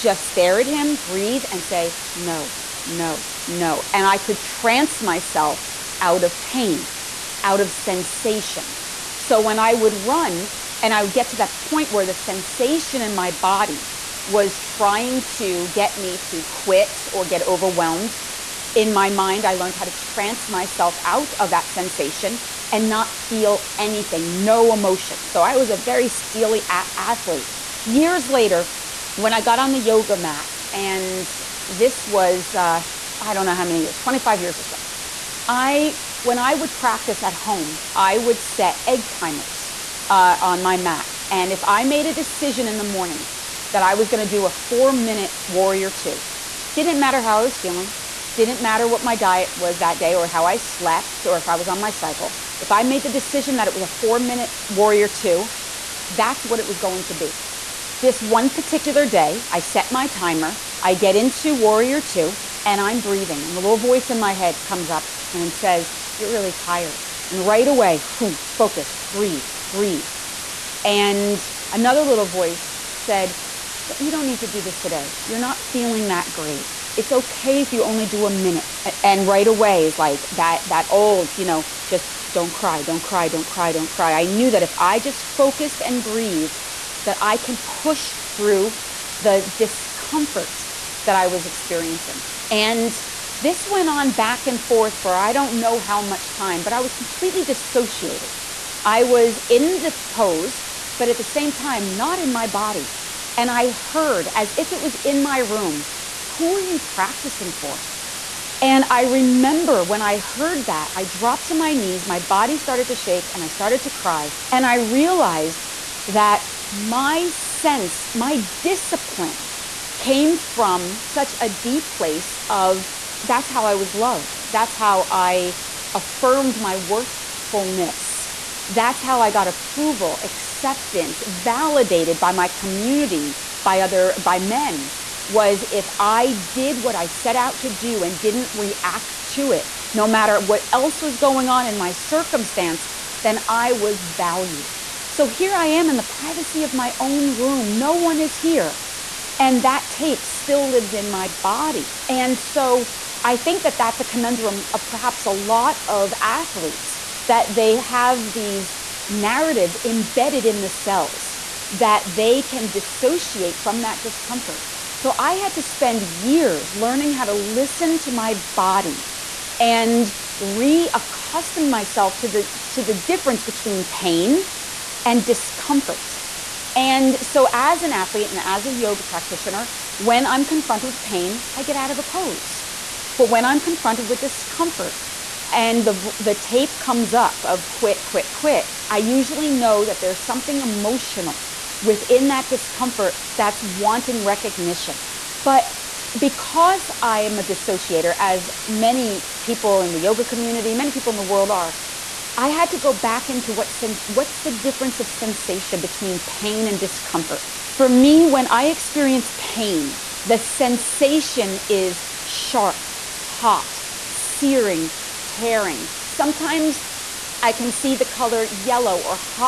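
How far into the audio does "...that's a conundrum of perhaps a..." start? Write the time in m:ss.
2:33.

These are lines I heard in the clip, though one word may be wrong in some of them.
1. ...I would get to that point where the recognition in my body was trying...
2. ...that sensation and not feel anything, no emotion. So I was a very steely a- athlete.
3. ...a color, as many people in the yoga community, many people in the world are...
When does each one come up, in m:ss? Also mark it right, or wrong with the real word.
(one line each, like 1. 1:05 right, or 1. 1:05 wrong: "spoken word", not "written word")
1. 0:10 wrong: "sensation", not "recognition"
2. 0:21 right
3. 3:17 wrong: "dissociator", not "color".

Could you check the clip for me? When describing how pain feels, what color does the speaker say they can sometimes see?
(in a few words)
yellow.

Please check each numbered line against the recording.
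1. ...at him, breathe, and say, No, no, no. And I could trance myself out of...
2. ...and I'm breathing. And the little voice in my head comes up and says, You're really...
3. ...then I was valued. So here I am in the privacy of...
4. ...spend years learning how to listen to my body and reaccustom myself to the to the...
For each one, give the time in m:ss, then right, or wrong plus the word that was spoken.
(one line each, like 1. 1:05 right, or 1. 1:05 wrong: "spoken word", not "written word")
1. 0:00 right
2. 1:02 right
3. 2:23 right
4. 2:45 right.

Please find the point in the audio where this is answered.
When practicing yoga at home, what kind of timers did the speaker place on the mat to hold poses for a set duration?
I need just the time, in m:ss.
0:38.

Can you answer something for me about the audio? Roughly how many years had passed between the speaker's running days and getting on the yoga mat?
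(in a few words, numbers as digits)
25.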